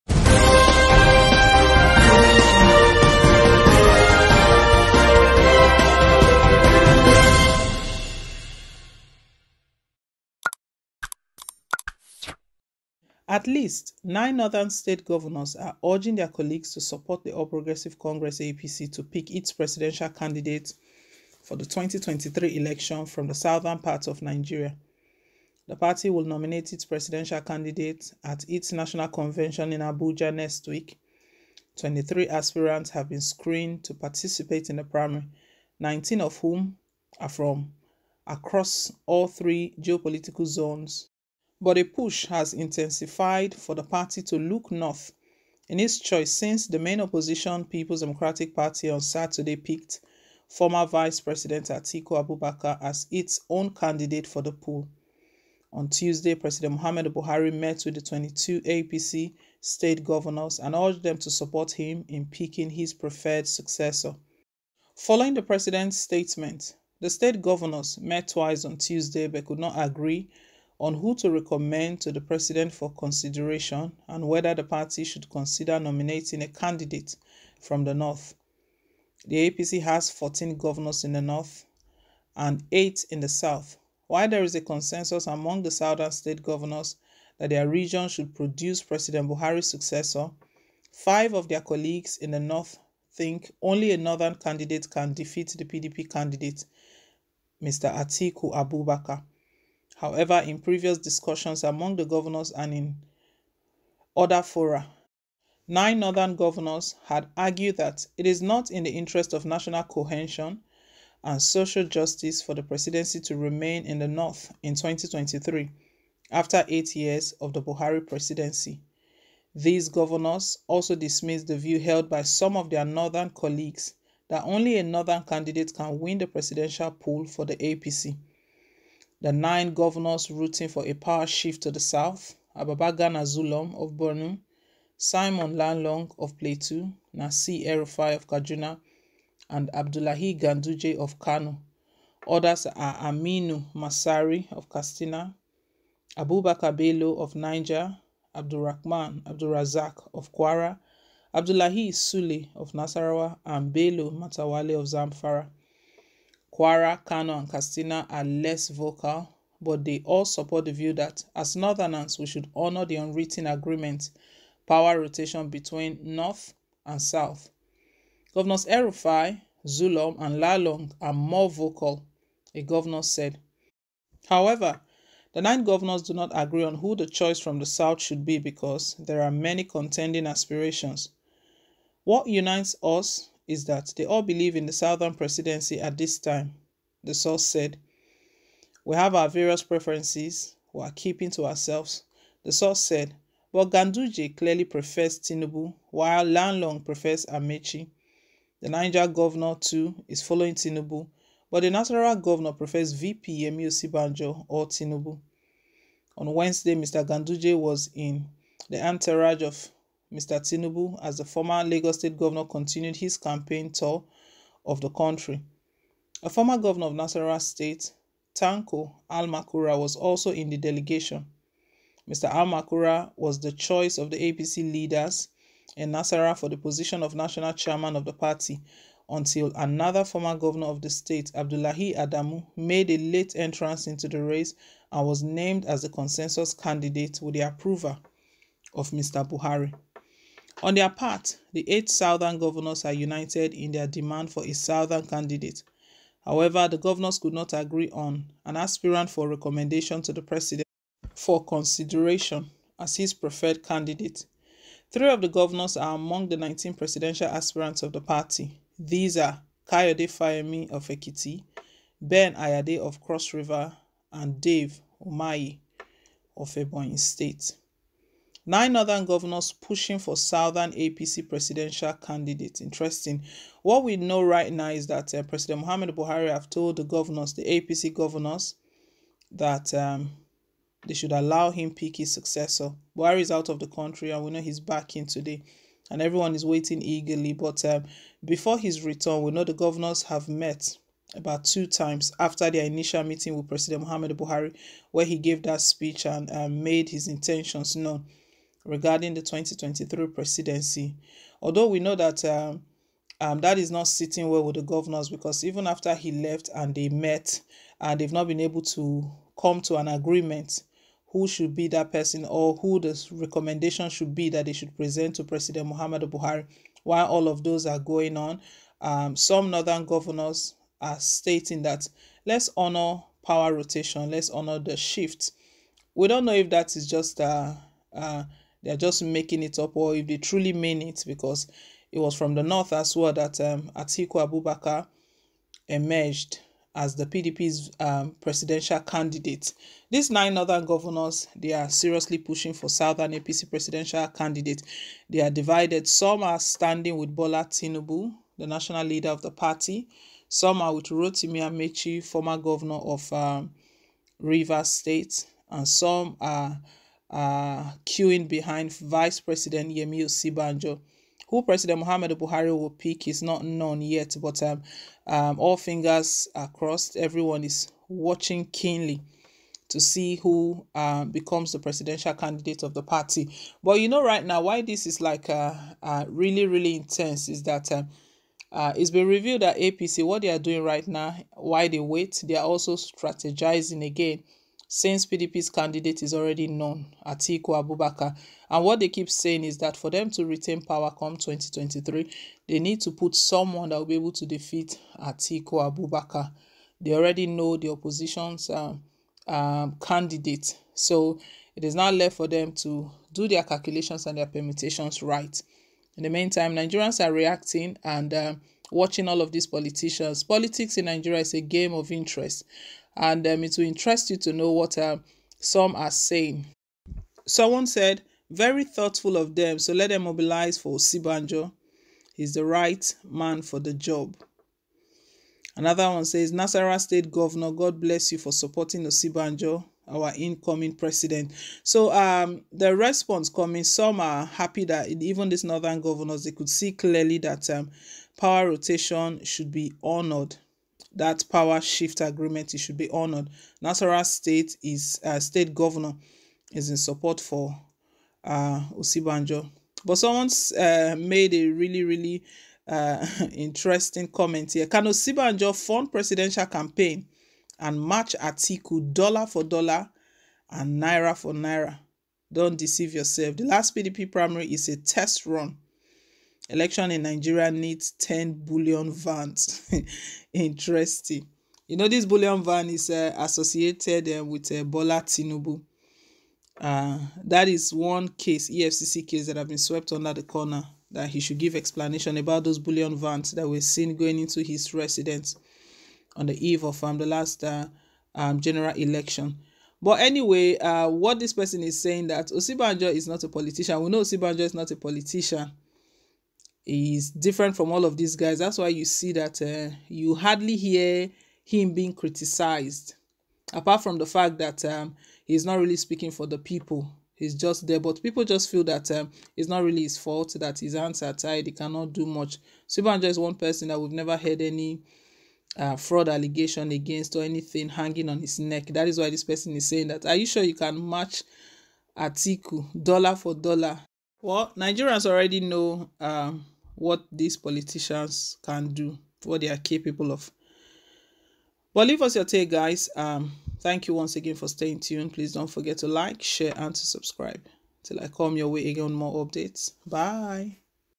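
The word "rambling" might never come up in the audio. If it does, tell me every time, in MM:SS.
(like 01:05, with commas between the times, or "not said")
not said.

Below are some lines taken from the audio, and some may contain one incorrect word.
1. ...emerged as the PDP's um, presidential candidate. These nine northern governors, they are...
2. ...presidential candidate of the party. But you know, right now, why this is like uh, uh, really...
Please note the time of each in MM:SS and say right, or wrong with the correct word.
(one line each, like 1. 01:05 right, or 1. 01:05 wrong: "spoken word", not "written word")
1. 05:35 right
2. 06:11 right.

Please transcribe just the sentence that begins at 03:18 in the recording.
The Niger governor, too, is following Tinubu, but the natural governor prefers VP Yemi Osinbajo or Tinubu.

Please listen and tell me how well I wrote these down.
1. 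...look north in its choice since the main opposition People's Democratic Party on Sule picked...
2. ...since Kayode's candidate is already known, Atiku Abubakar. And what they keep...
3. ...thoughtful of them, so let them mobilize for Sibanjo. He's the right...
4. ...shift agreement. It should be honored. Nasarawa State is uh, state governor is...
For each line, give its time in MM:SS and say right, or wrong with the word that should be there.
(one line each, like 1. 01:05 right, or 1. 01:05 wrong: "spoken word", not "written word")
1. 00:44 wrong: "Saturday", not "Sule"
2. 06:24 wrong: "PDP", not "Kayode"
3. 06:58 right
4. 07:21 right.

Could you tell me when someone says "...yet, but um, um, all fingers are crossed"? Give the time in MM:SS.
06:03.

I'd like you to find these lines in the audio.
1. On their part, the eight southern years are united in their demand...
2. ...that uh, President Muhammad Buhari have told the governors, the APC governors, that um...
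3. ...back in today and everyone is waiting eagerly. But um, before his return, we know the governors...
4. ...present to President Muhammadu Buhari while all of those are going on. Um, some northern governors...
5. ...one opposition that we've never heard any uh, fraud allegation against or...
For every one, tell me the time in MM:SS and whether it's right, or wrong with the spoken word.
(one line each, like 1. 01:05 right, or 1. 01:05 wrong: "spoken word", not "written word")
1. 04:00 wrong: "governors", not "years"
2. 04:34 right
3. 04:44 right
4. 05:14 right
5. 08:33 wrong: "person", not "opposition".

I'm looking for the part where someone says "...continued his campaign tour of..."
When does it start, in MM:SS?
03:32.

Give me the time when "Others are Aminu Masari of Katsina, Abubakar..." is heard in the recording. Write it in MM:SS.
02:22.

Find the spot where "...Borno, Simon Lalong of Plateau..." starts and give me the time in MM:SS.
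02:13.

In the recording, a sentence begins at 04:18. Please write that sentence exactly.
These are Kayode Fayemi of Ekiti, Ben Ayade of Cross River, and Dave Umahi of Ebonyi State.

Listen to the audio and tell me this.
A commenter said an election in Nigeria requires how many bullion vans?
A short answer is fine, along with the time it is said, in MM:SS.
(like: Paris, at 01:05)
10, at 07:47.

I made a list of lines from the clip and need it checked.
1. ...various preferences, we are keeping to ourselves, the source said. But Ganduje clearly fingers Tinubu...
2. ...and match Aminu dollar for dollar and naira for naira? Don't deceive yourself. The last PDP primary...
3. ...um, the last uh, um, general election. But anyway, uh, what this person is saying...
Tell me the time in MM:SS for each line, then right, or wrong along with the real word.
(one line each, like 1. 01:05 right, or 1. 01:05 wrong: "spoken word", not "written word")
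1. 03:09 wrong: "prefers", not "fingers"
2. 07:37 wrong: "Atiku", not "Aminu"
3. 08:06 right.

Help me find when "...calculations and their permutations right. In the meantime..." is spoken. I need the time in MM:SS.
06:43.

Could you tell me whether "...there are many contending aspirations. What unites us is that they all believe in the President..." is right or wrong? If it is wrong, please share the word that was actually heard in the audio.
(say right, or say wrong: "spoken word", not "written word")
wrong: "Southern", not "President".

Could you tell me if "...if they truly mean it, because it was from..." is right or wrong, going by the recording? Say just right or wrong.
right.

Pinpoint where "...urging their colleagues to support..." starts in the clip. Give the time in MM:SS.
00:15.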